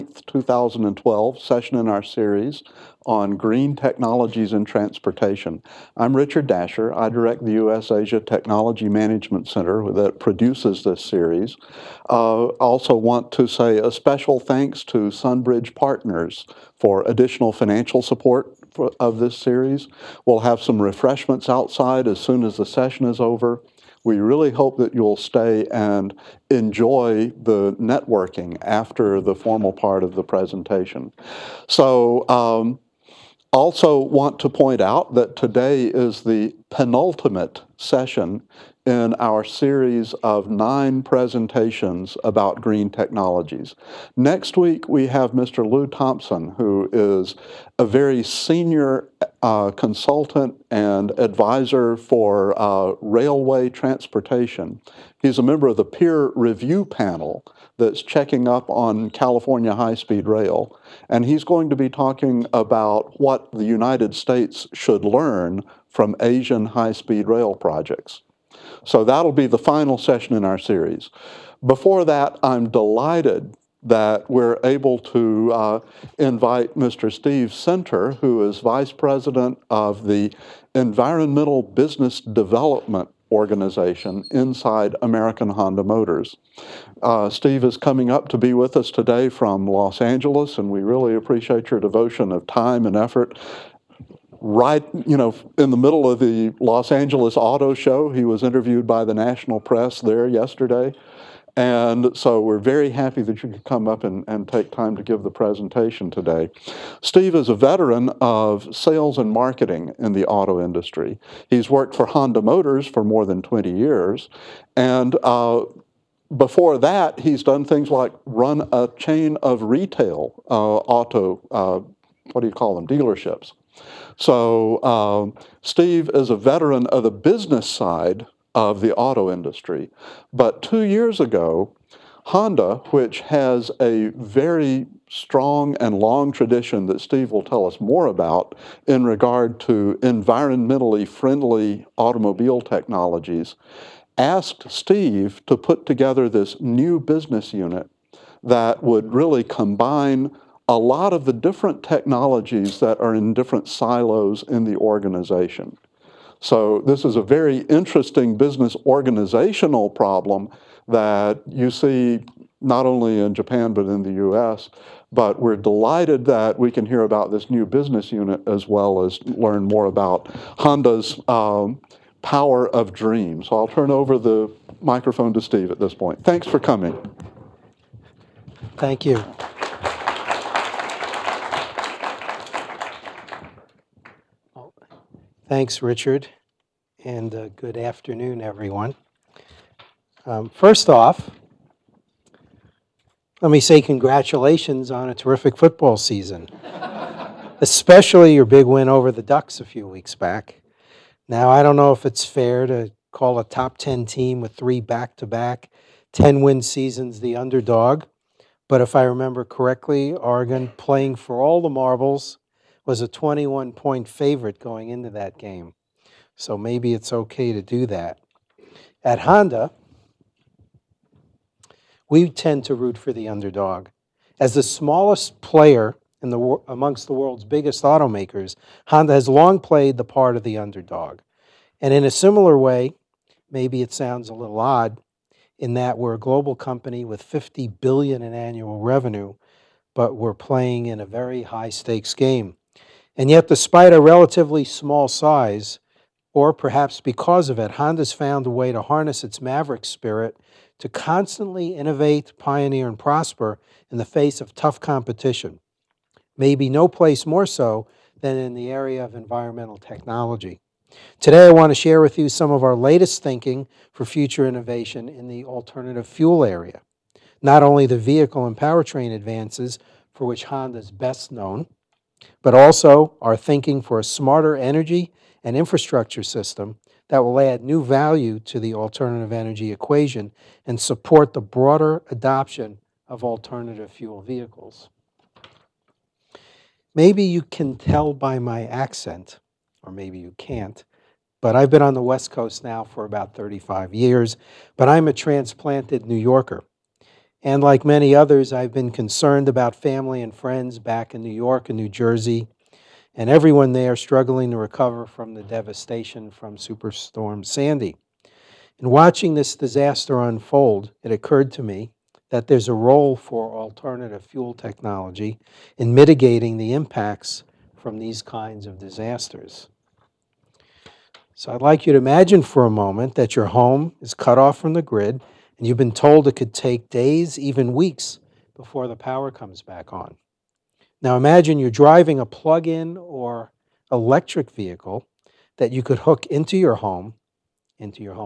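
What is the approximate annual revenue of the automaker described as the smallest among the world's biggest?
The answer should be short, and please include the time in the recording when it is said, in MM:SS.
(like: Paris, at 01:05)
50 billion, at 03:57.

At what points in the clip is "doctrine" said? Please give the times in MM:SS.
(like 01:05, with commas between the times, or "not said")
not said.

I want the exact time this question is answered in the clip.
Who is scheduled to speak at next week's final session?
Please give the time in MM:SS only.
00:45.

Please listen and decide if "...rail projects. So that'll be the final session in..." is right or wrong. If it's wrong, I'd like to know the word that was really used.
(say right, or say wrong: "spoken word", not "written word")
right.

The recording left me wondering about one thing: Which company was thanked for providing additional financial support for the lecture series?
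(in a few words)
Sunbridge Partners.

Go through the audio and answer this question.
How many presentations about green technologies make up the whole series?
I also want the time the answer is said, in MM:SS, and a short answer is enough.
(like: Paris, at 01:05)
9, at 00:40.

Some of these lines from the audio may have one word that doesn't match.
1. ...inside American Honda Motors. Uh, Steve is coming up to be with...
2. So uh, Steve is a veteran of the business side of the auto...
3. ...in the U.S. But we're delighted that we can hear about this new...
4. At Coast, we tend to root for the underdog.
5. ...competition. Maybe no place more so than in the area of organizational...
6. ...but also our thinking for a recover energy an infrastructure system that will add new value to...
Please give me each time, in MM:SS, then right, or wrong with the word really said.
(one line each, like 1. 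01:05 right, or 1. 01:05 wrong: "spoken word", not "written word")
1. 01:24 right
2. 02:04 right
3. 02:43 right
4. 03:39 wrong: "Honda", not "Coast"
5. 04:14 wrong: "environmental", not "organizational"
6. 04:32 wrong: "smarter", not "recover".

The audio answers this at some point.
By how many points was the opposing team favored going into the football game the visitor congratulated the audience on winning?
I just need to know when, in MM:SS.
03:33.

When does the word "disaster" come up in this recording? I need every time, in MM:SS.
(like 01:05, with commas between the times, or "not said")
05:09, 05:18.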